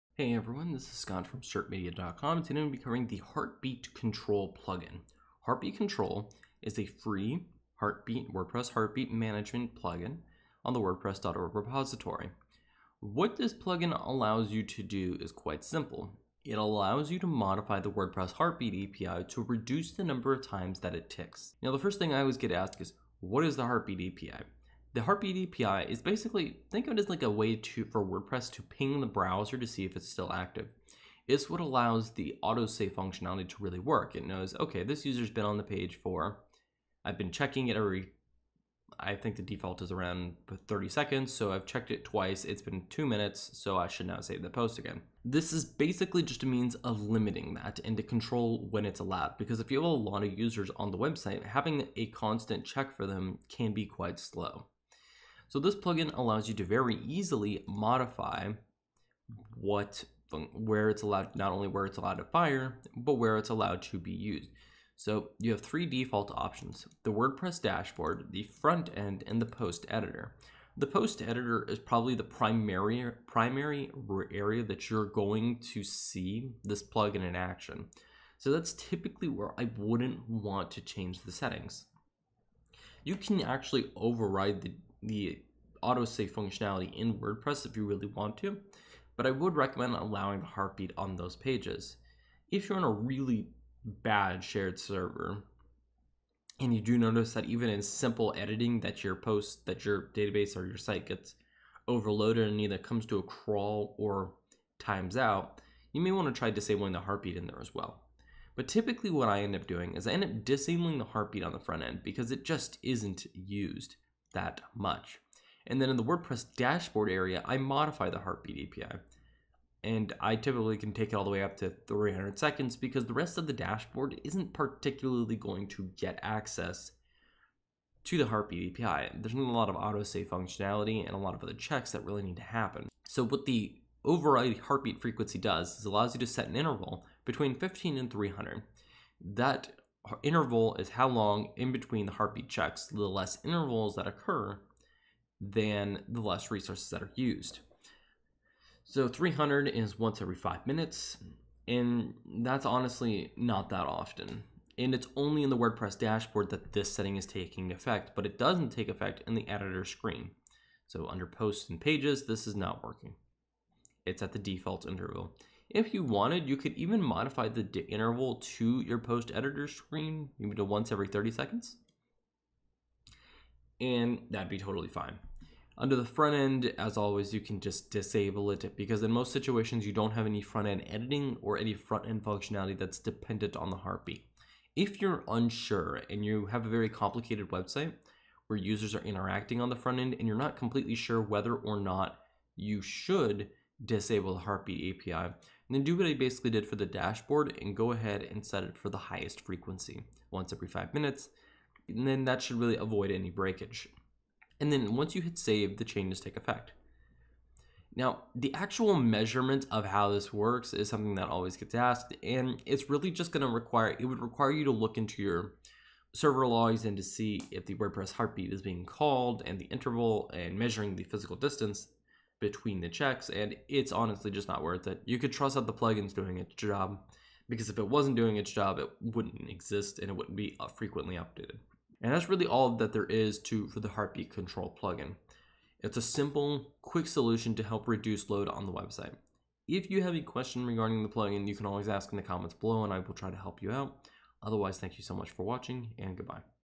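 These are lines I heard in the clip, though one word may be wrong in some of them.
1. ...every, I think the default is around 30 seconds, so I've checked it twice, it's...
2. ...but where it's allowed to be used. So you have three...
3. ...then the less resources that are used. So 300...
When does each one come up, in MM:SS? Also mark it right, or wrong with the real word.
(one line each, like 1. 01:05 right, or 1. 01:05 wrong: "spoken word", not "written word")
1. 00:37 right
2. 01:02 right
3. 02:25 right.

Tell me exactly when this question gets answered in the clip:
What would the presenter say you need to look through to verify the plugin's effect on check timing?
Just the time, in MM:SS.
03:36.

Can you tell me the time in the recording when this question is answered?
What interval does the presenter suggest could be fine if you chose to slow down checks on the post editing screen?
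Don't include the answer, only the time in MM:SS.
02:50.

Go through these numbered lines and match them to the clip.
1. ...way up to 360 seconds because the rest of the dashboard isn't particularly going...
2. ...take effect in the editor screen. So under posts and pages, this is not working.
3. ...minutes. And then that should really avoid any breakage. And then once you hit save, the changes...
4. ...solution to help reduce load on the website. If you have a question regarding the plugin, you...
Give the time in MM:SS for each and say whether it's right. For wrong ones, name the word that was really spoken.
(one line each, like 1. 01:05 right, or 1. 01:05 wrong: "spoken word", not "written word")
1. 02:01 wrong: "300", not "360"
2. 02:38 right
3. 03:20 right
4. 03:57 right.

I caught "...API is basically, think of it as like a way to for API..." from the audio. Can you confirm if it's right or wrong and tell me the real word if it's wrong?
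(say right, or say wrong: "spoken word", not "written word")
wrong: "WordPress", not "API".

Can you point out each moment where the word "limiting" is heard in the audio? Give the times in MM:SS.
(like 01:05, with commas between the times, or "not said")
00:47.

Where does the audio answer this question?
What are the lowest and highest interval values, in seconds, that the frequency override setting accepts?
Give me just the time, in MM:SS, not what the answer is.
02:17.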